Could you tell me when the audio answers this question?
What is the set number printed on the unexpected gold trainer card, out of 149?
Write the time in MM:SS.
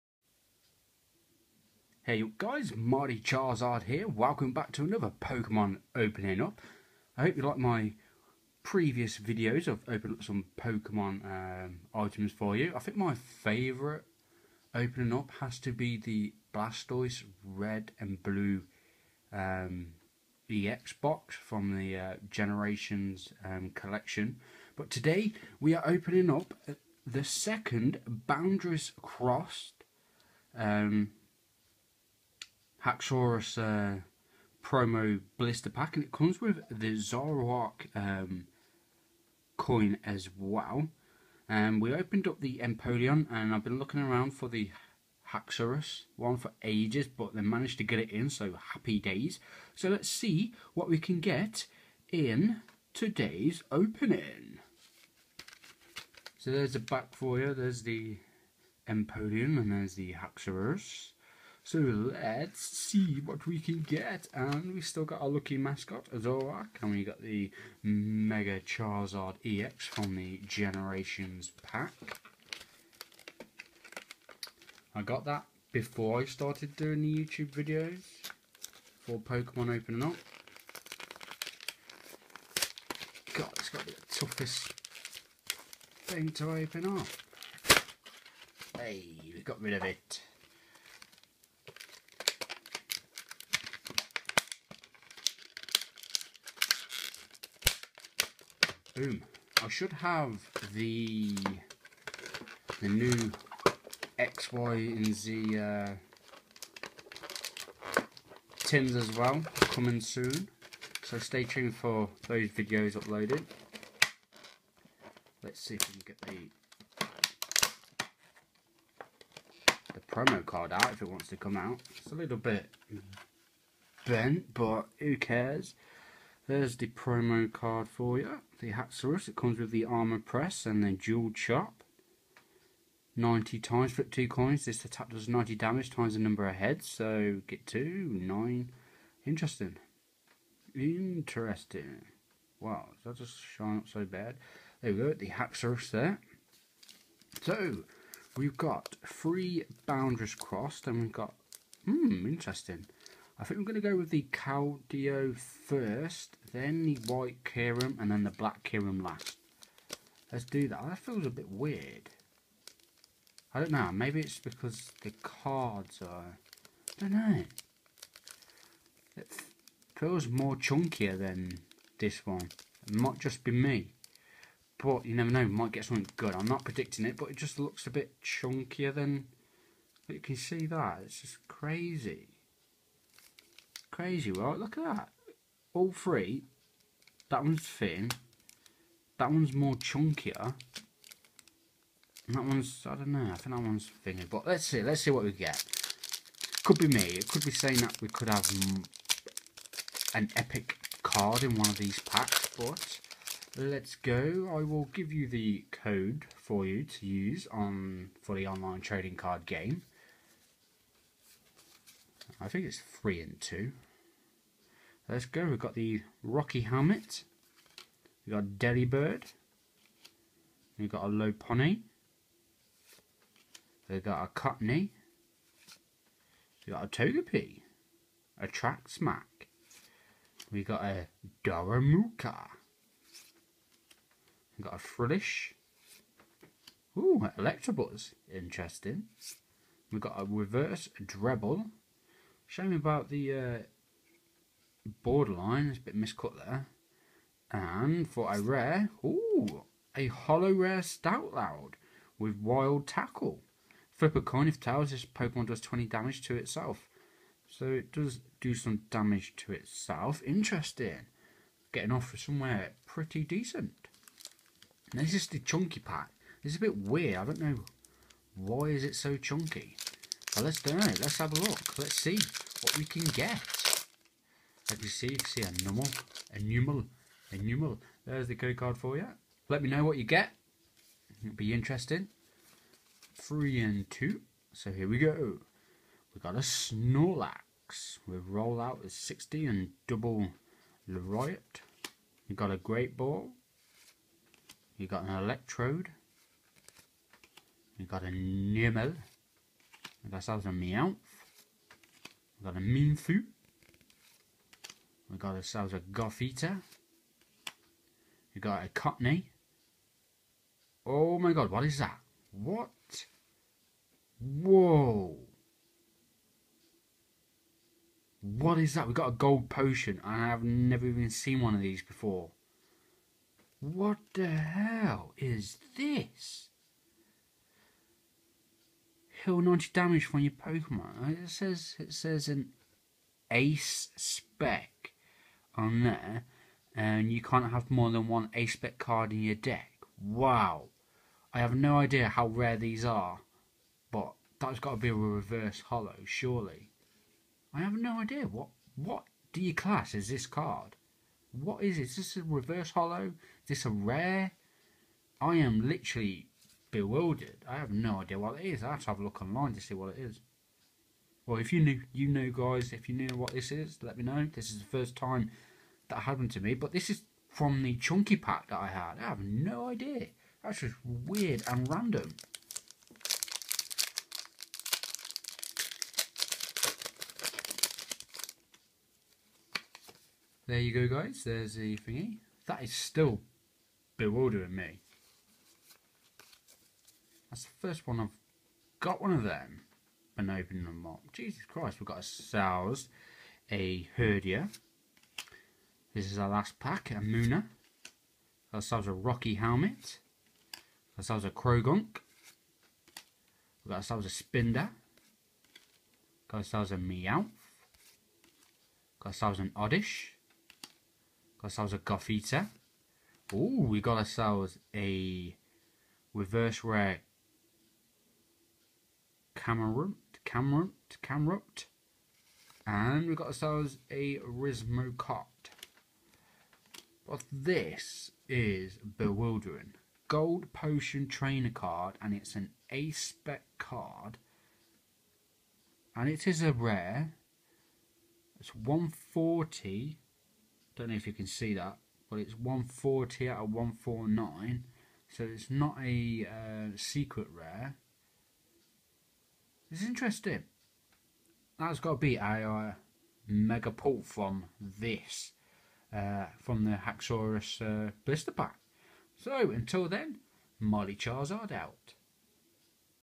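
07:22.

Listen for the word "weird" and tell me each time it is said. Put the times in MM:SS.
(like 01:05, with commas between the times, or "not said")
02:41, 04:26, 06:10.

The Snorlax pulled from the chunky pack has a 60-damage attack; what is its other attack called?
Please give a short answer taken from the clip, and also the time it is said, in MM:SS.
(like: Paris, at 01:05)
Double Lariat, at 04:49.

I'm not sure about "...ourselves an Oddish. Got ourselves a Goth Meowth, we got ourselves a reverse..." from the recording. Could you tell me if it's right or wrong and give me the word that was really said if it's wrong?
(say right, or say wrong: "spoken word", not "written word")
wrong: "Ooh", not "Meowth".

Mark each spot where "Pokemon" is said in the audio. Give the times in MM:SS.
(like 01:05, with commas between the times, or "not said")
00:05, 00:10, 01:19, 04:15, 05:30.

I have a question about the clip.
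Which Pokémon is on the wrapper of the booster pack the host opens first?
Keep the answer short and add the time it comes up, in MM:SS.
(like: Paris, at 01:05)
Keldeo, at 02:34.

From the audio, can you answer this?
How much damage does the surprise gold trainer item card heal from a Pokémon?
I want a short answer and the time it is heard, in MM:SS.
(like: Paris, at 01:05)
90, at 05:29.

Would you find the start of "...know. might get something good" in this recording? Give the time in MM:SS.
02:55.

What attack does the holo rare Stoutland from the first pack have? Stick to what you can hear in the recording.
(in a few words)
Wild Tackle.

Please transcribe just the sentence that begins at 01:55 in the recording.
Let's see if we can get the the promo card out if it wants to come out.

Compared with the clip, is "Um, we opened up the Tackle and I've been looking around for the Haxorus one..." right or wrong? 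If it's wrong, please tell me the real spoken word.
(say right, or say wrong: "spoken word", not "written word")
wrong: "Empoleon", not "Tackle".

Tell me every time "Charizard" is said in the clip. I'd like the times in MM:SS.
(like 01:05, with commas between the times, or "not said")
00:03, 01:08, 07:40.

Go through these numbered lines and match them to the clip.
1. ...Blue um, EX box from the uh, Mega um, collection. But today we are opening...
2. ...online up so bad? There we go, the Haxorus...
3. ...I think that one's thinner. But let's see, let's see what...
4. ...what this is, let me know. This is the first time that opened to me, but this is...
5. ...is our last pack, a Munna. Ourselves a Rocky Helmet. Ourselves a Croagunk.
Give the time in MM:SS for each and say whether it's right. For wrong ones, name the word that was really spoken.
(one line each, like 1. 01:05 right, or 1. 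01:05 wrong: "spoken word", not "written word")
1. 00:18 wrong: "Generations", not "Mega"
2. 02:23 wrong: "shine", not "online"
3. 03:13 right
4. 06:03 wrong: "happened", not "opened"
5. 06:36 right.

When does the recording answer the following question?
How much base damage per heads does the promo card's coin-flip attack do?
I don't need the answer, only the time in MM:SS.
02:15.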